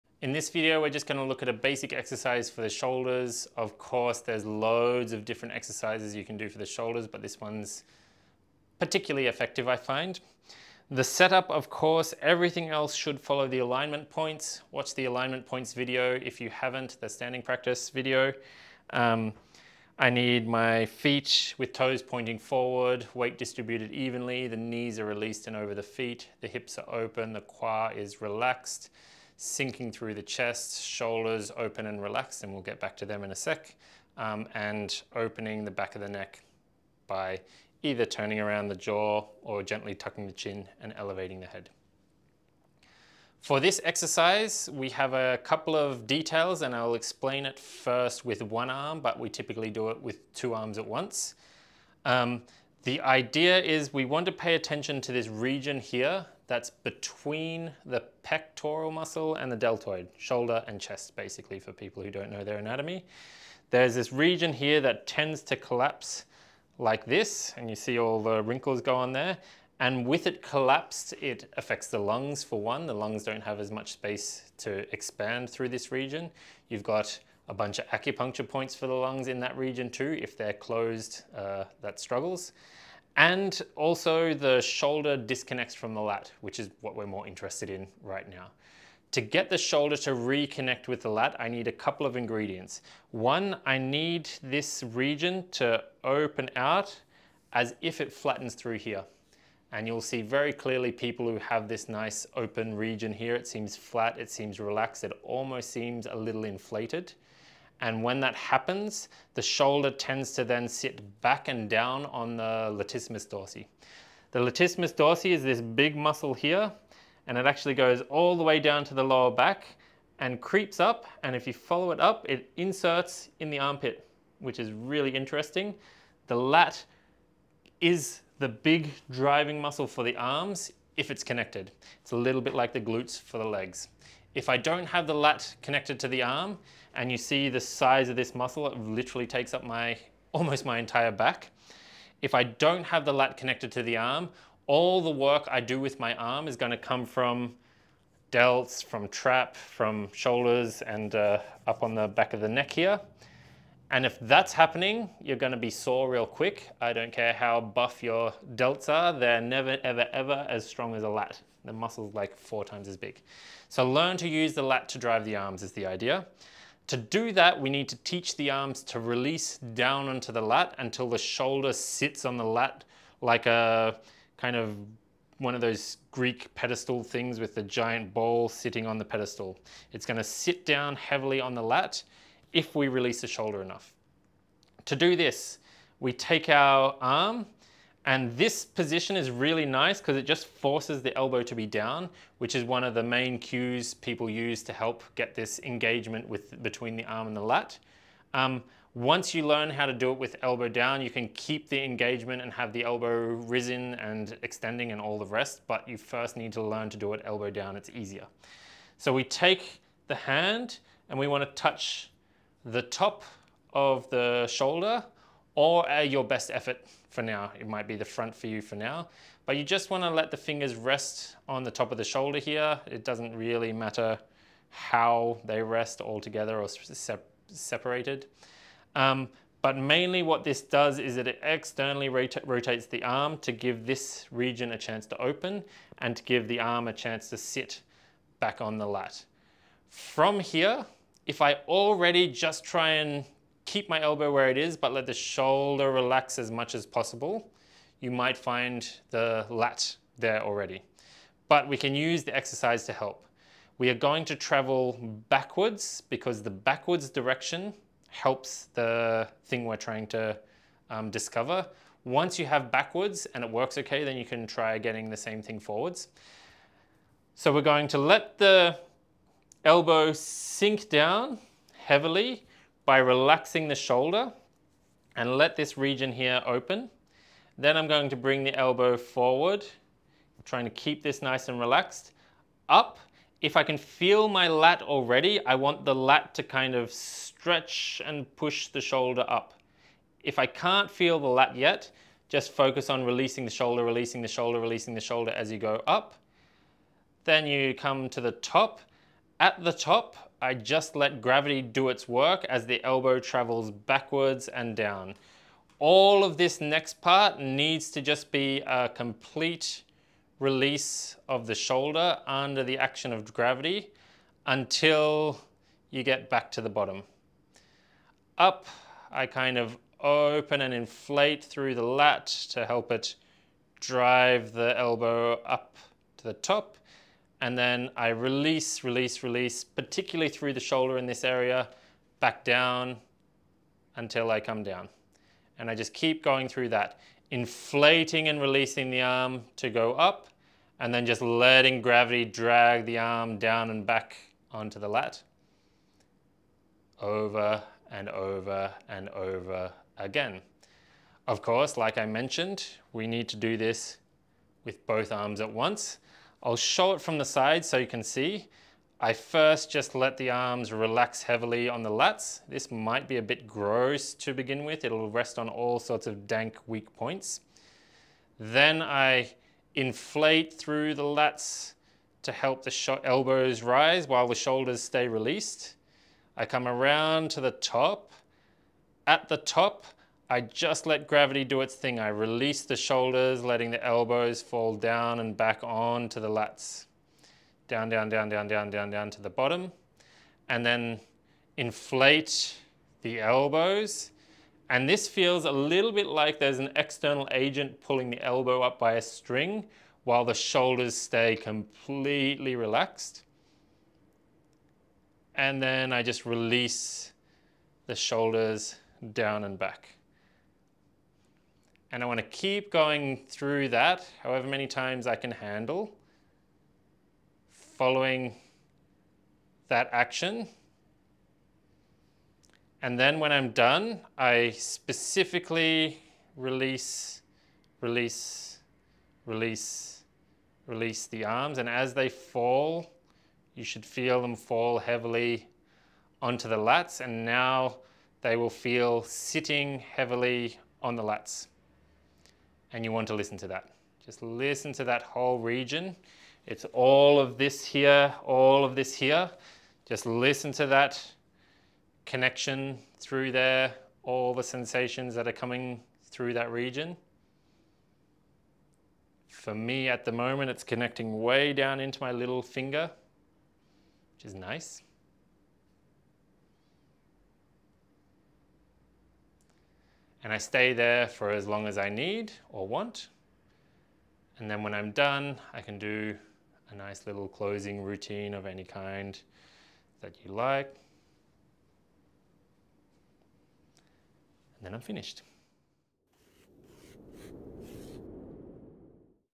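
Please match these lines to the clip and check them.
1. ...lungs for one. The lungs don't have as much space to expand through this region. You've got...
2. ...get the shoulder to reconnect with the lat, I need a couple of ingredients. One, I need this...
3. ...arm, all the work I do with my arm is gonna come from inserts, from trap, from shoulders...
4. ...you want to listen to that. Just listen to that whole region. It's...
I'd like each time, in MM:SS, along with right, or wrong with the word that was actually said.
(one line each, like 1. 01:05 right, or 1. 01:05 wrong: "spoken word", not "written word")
1. 01:11 right
2. 01:29 right
3. 02:23 wrong: "delts", not "inserts"
4. 07:22 right.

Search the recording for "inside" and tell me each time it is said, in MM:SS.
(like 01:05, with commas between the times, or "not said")
not said.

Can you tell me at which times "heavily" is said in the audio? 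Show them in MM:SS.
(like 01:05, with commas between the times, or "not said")
03:00, 04:31, 06:01, 07:14, 07:19.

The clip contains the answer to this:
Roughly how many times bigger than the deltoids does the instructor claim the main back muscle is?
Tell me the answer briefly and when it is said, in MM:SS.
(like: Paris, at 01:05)
4, at 02:42.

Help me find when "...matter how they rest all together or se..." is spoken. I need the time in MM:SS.
03:43.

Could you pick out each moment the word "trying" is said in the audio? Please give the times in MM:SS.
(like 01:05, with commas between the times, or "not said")
04:19, 04:40.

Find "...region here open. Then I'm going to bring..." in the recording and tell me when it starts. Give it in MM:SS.
04:35.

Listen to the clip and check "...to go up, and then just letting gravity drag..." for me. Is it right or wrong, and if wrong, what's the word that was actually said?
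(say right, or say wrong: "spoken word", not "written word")
right.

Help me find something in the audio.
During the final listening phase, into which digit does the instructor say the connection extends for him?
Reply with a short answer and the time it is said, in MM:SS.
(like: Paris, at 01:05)
little finger, at 07:42.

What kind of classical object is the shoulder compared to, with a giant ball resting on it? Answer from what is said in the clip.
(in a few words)
Greek pedestal.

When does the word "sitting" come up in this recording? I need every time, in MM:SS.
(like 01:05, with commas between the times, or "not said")
02:58, 07:19.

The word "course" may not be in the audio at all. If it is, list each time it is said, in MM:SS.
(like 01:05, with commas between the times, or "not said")
00:03, 00:11, 05:51.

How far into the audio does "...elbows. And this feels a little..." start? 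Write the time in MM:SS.
06:33.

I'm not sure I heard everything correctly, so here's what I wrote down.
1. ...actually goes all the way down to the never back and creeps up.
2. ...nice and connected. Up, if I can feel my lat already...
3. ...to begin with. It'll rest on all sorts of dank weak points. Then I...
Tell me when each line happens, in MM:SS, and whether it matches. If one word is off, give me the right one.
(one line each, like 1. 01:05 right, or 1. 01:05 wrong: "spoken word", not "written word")
1. 01:57 wrong: "lower", not "never"
2. 04:41 wrong: "relaxed", not "connected"
3. 06:04 right.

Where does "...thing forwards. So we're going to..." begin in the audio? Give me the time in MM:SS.
04:25.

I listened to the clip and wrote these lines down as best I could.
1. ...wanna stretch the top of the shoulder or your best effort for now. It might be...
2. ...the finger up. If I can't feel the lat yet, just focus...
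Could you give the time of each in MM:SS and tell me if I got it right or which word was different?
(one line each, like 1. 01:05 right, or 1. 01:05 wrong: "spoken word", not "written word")
1. 03:31 wrong: "touch", not "stretch"
2. 04:48 wrong: "shoulder", not "finger".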